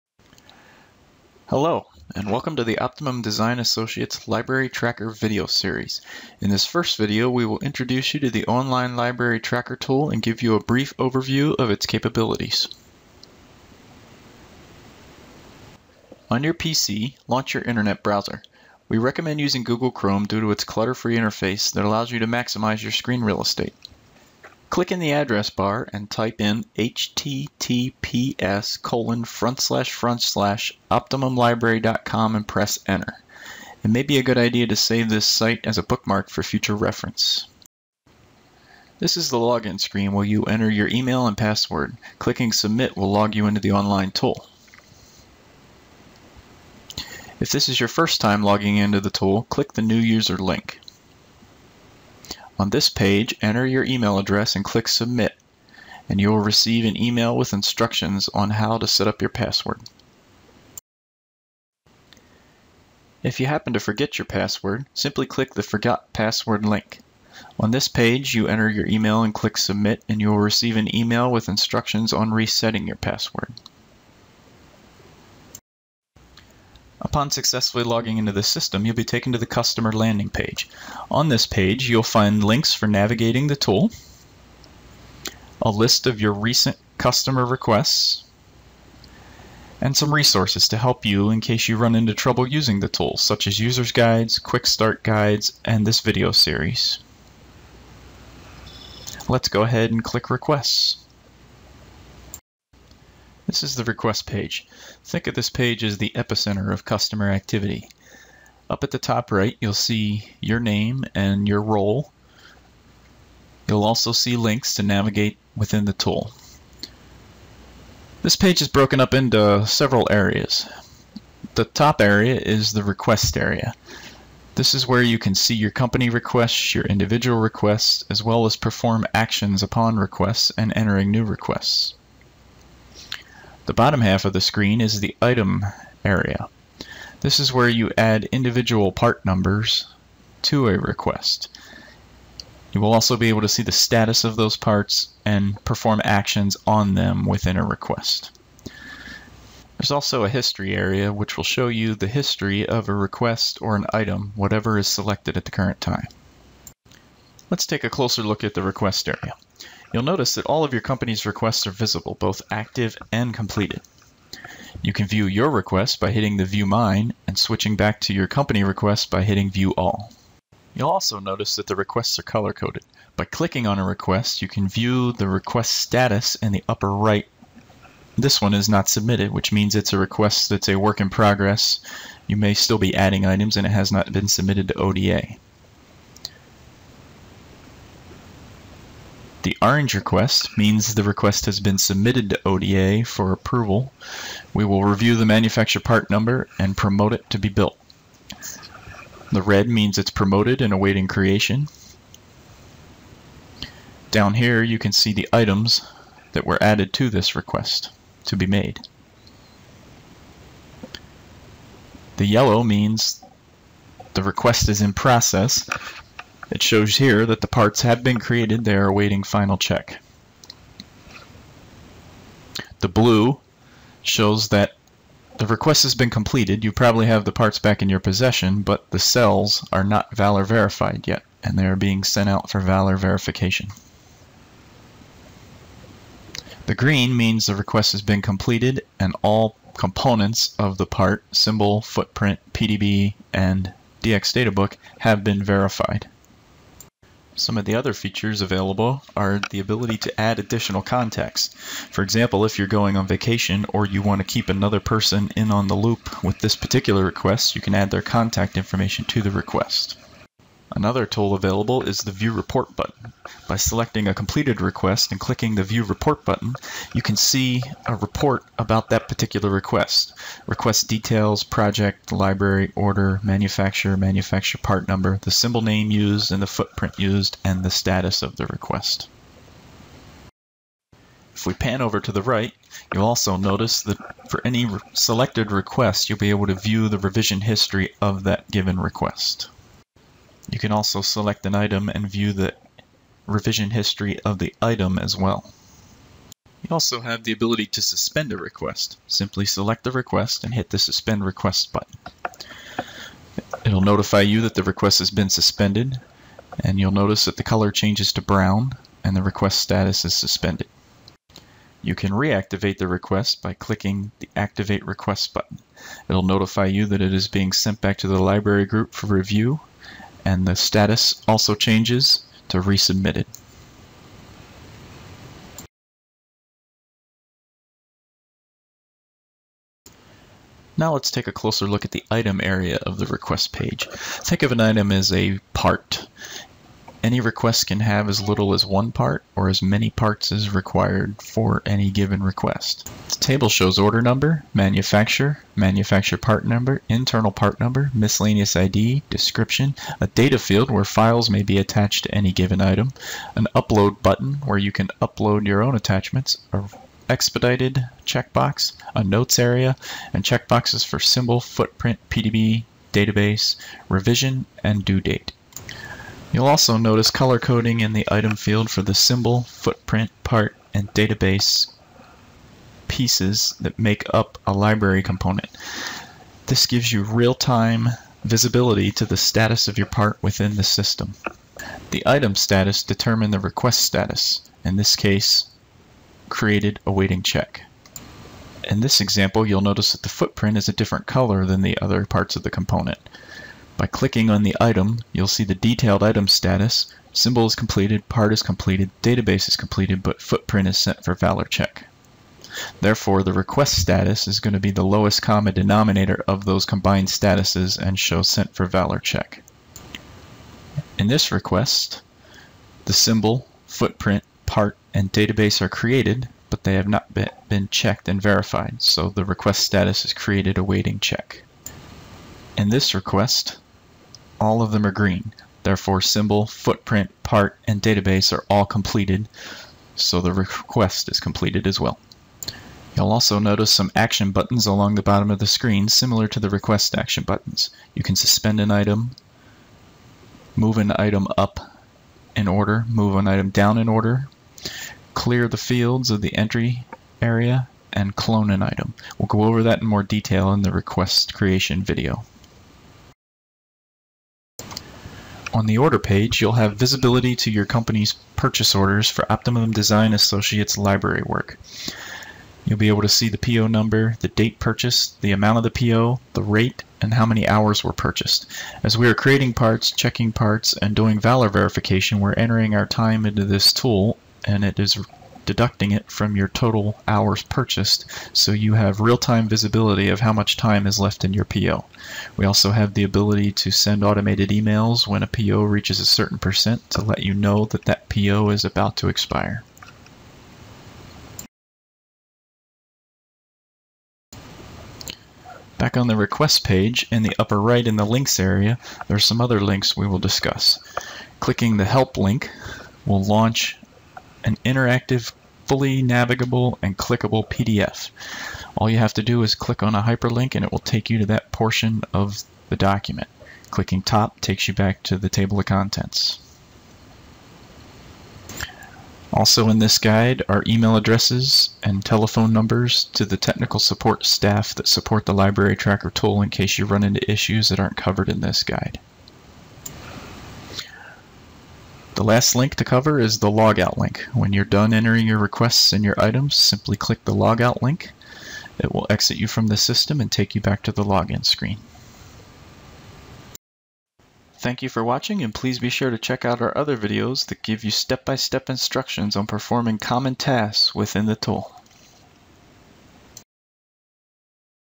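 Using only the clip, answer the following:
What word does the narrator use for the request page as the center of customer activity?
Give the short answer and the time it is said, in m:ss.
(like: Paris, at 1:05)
epicenter, at 1:46.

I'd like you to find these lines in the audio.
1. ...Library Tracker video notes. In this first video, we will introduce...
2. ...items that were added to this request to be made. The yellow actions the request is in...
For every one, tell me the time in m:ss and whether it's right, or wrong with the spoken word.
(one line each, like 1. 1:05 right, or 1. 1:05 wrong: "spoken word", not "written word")
1. 0:04 wrong: "series", not "notes"
2. 3:25 wrong: "means", not "actions".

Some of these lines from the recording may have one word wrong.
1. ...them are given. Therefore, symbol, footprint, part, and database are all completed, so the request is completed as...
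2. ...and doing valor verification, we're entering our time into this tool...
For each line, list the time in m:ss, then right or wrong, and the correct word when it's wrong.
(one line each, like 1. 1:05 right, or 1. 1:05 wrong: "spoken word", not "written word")
1. 7:04 wrong: "green", not "given"
2. 7:50 right.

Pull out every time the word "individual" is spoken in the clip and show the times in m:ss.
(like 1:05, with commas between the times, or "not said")
2:06, 2:18.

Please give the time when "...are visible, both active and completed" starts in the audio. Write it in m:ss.
2:41.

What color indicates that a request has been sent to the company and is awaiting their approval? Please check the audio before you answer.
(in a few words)
orange.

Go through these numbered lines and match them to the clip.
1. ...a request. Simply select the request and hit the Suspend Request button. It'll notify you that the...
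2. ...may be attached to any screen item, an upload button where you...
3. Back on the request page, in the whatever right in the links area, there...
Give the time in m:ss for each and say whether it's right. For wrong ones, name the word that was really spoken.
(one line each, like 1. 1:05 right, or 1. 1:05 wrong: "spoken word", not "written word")
1. 4:58 right
2. 5:51 wrong: "given", not "screen"
3. 8:15 wrong: "upper", not "whatever".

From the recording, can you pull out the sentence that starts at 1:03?
If you happen to forget your password, simply click the Forgot Password link.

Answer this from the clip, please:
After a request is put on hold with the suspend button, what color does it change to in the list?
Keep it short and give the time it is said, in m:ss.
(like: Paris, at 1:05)
brown, at 5:08.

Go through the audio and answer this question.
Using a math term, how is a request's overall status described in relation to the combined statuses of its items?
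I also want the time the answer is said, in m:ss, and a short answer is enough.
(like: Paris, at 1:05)
lowest common denominator, at 6:44.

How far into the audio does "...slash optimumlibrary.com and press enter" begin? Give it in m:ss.
0:30.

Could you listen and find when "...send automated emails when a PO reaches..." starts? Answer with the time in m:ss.
8:03.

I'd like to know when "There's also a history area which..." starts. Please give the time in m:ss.
2:29.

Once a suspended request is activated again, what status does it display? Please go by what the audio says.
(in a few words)
resubmitted.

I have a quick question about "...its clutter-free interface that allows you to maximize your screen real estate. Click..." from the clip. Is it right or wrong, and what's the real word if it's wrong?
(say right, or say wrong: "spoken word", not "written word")
right.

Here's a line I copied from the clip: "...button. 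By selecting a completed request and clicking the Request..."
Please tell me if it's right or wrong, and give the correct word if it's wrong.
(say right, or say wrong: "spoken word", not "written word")
wrong: "View", not "Request".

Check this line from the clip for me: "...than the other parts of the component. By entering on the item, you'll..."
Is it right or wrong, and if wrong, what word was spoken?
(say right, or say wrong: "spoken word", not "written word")
wrong: "clicking", not "entering".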